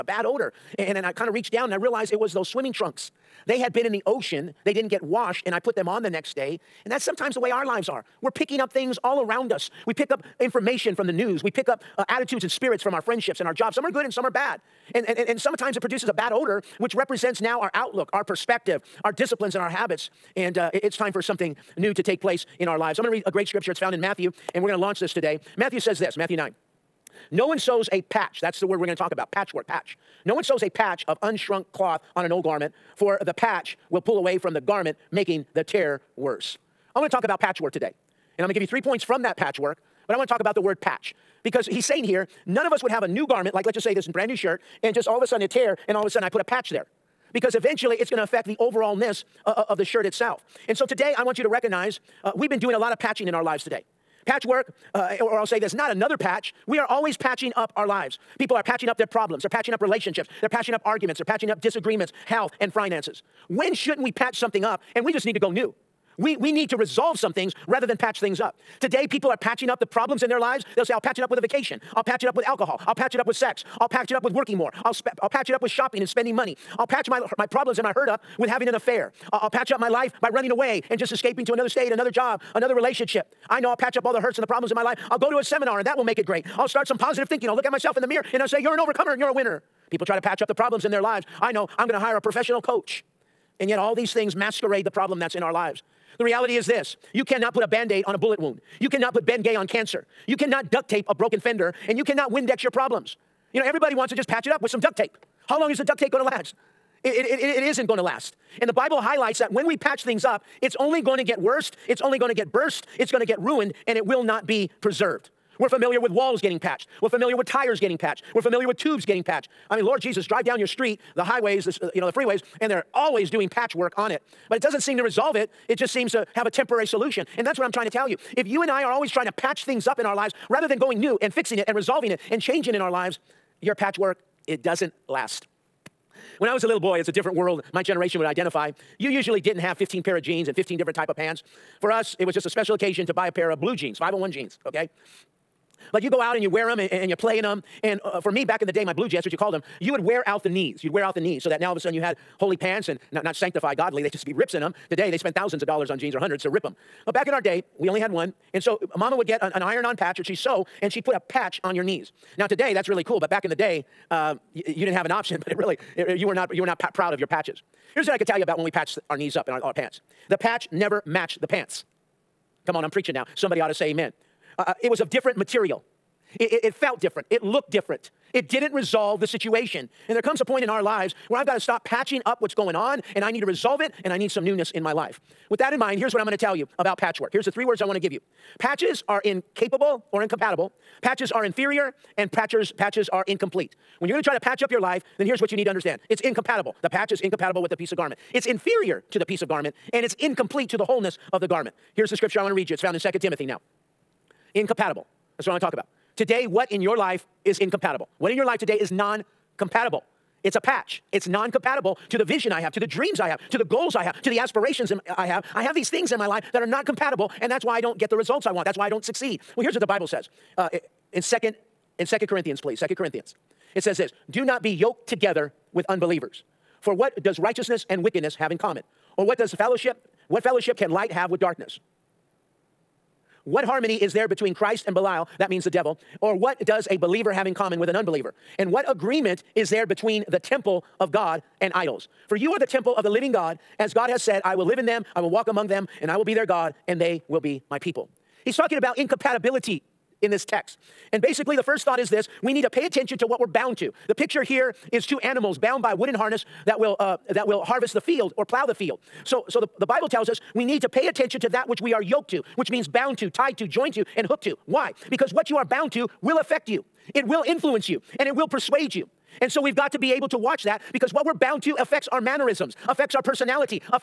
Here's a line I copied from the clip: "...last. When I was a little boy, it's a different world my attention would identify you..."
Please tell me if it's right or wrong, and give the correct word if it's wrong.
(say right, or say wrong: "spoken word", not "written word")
wrong: "generation", not "attention".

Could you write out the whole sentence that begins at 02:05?
It just seems to have a temporary solution.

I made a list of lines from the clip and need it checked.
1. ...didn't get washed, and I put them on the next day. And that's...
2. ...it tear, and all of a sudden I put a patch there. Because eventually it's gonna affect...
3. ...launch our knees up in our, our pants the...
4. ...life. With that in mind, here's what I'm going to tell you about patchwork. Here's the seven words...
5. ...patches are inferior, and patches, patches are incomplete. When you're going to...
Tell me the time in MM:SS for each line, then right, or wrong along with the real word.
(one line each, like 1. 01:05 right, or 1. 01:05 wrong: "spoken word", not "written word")
1. 00:04 right
2. 00:45 right
3. 02:48 wrong: "patch", not "launch"
4. 03:04 wrong: "three", not "seven"
5. 03:11 right.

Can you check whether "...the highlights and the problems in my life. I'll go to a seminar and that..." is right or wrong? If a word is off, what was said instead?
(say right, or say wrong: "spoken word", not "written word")
wrong: "hurts", not "highlights".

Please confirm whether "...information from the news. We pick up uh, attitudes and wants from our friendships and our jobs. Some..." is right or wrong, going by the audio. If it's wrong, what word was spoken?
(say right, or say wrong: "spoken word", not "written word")
wrong: "spirits", not "wants".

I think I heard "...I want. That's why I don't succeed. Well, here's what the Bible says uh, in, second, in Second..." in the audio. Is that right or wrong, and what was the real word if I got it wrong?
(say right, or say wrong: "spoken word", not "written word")
right.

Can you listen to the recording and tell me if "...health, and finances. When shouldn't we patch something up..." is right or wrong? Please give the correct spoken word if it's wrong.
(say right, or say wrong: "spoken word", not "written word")
right.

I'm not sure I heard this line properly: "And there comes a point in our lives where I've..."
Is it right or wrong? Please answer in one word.
right.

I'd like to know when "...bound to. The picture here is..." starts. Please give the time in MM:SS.
04:13.